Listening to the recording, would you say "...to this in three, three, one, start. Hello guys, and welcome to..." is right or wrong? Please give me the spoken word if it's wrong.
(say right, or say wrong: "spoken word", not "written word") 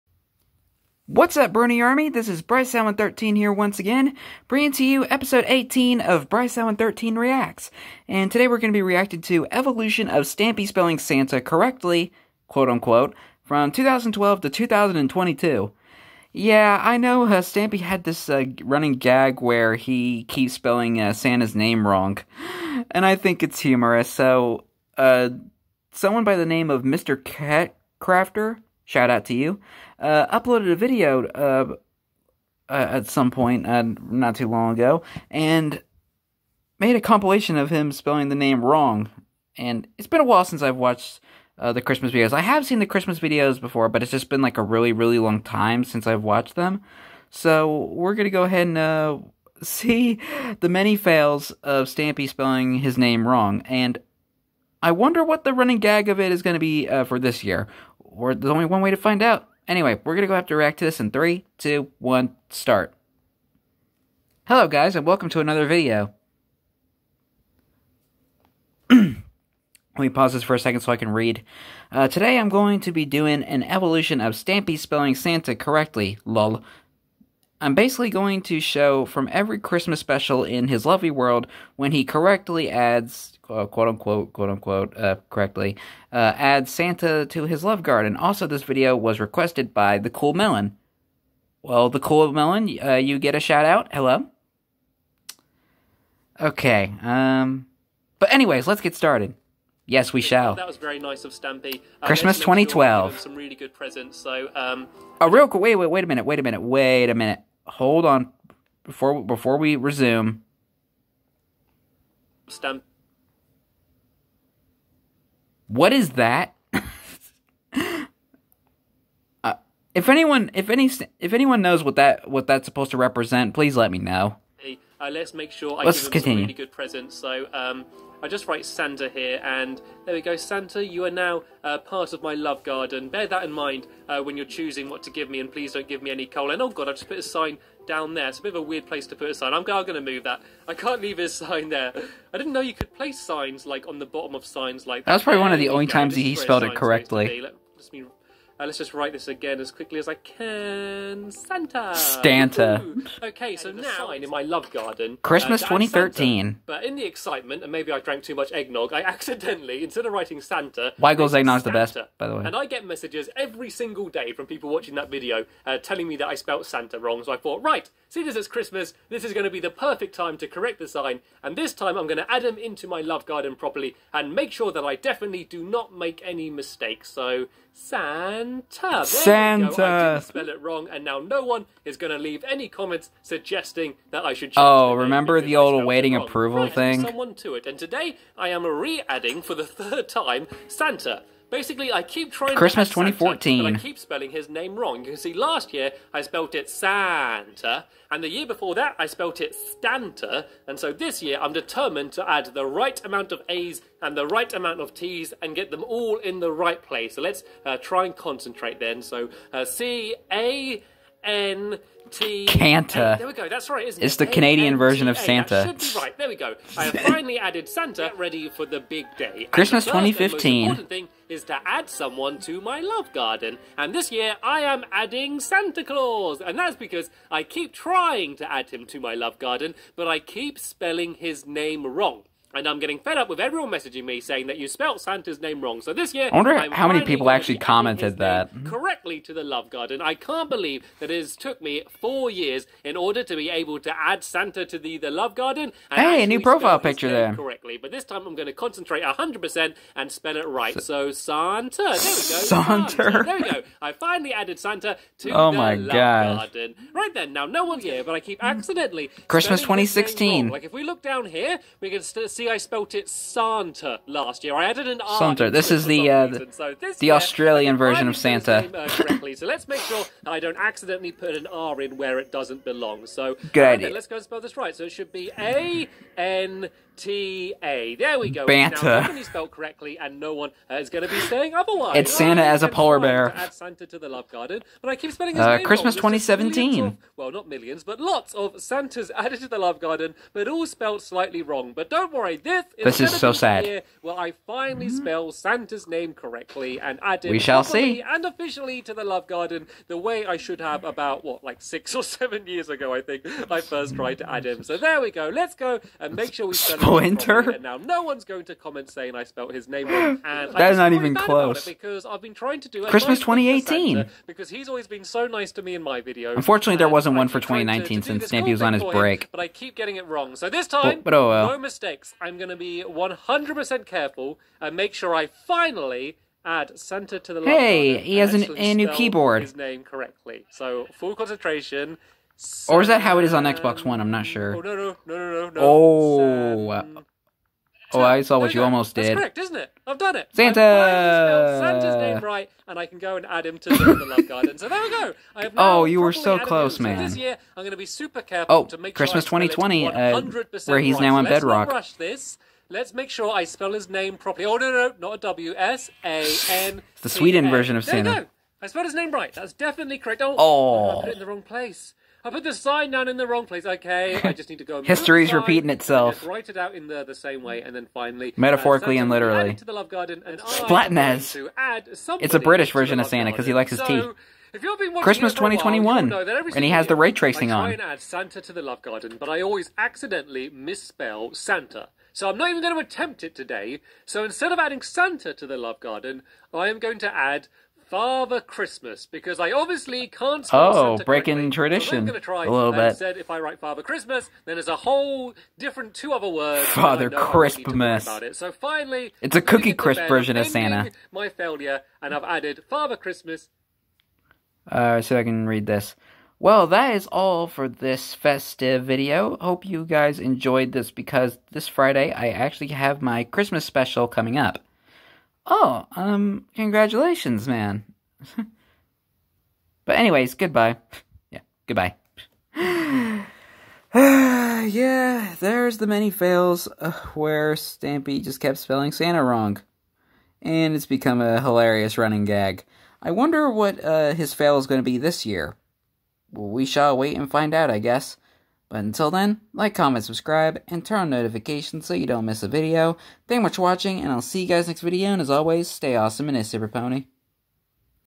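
wrong: "two", not "three".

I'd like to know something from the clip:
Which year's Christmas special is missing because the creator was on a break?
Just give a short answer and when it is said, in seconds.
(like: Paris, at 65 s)
2019, at 317 s.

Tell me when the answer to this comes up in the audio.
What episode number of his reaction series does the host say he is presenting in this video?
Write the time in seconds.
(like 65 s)
5 s.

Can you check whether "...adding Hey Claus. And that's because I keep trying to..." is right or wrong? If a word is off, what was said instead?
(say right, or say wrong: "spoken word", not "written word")
wrong: "Santa", not "Hey".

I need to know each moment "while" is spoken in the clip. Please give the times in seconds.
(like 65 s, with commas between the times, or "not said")
40 s, 376 s.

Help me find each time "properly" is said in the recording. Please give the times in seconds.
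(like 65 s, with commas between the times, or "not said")
173 s, 354 s.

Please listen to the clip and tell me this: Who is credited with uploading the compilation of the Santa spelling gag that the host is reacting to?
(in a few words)
Mr. Cat Crafter.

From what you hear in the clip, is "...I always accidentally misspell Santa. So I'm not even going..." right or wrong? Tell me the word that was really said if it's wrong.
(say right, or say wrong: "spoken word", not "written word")
right.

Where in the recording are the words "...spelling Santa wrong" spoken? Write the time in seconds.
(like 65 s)
428 s.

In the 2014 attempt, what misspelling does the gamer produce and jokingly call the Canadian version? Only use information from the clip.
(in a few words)
Canta.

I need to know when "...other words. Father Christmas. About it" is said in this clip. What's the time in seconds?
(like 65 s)
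396 s.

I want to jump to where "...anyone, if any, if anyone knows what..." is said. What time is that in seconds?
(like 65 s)
120 s.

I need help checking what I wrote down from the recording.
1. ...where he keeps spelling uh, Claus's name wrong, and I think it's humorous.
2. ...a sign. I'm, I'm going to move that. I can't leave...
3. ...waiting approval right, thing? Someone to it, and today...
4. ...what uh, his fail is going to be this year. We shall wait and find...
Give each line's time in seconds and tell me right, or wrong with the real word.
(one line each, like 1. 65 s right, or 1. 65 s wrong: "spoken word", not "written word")
1. 19 s wrong: "Santa", not "Claus"
2. 139 s right
3. 185 s right
4. 433 s right.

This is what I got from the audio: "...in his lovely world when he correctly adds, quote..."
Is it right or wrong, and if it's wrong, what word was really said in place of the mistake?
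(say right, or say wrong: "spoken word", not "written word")
right.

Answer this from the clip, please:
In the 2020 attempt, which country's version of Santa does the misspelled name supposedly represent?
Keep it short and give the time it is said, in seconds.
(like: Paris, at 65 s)
Sweden, at 357 s.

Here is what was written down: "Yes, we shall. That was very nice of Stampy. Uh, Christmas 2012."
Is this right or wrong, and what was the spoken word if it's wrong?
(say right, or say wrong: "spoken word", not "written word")
right.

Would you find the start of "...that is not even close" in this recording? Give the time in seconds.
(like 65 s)
310 s.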